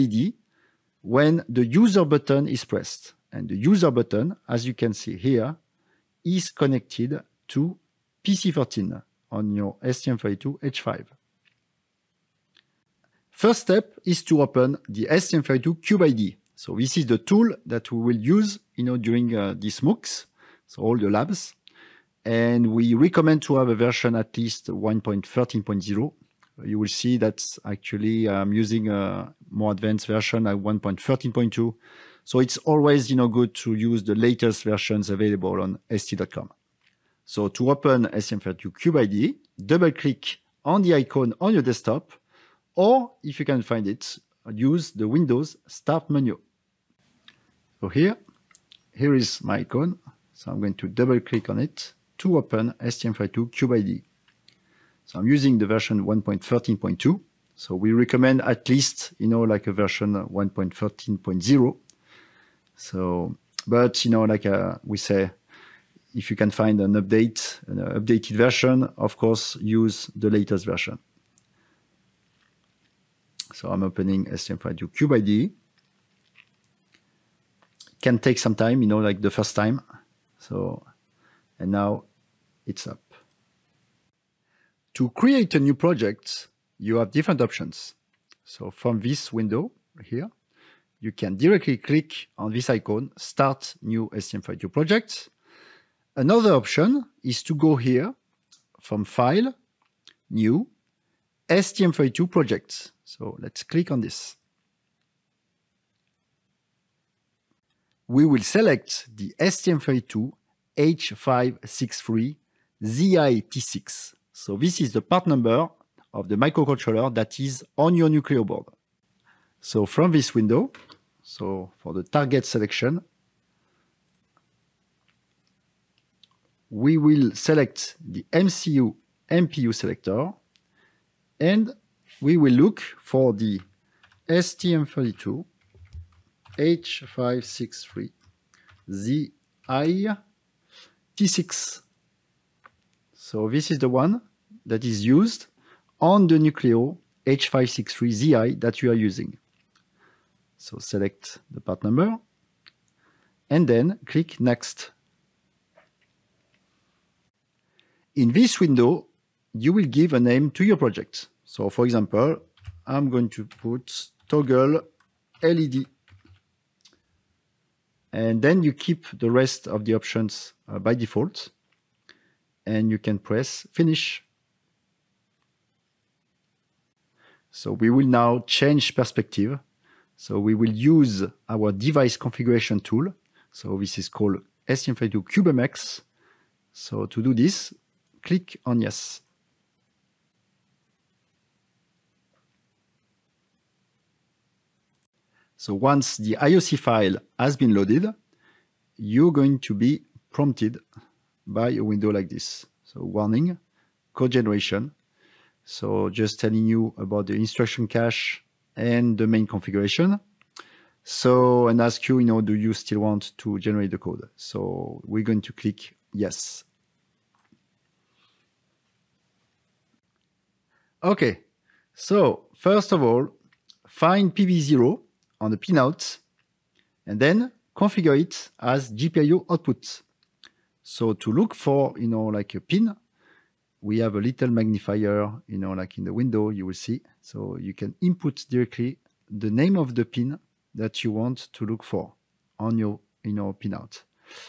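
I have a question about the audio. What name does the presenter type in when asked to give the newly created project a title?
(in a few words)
toggle LED.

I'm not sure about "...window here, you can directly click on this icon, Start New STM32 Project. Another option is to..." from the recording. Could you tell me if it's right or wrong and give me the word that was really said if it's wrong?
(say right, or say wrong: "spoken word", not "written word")
right.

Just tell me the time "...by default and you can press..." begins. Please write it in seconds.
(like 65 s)
170 s.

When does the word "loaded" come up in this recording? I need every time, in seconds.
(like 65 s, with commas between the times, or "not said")
197 s.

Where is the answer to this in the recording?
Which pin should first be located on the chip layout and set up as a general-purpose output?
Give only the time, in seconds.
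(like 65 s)
224 s.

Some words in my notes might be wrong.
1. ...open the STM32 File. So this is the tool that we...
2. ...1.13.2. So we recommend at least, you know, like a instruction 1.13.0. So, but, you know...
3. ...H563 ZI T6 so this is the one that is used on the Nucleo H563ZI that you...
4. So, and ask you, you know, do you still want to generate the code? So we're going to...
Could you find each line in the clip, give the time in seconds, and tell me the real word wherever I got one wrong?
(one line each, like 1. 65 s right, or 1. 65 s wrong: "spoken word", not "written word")
1. 14 s wrong: "CubeIDE", not "File"
2. 56 s wrong: "version", not "instruction"
3. 136 s right
4. 211 s right.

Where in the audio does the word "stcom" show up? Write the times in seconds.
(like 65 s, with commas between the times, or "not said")
35 s.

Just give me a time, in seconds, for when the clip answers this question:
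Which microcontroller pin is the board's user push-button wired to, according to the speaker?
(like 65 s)
8 s.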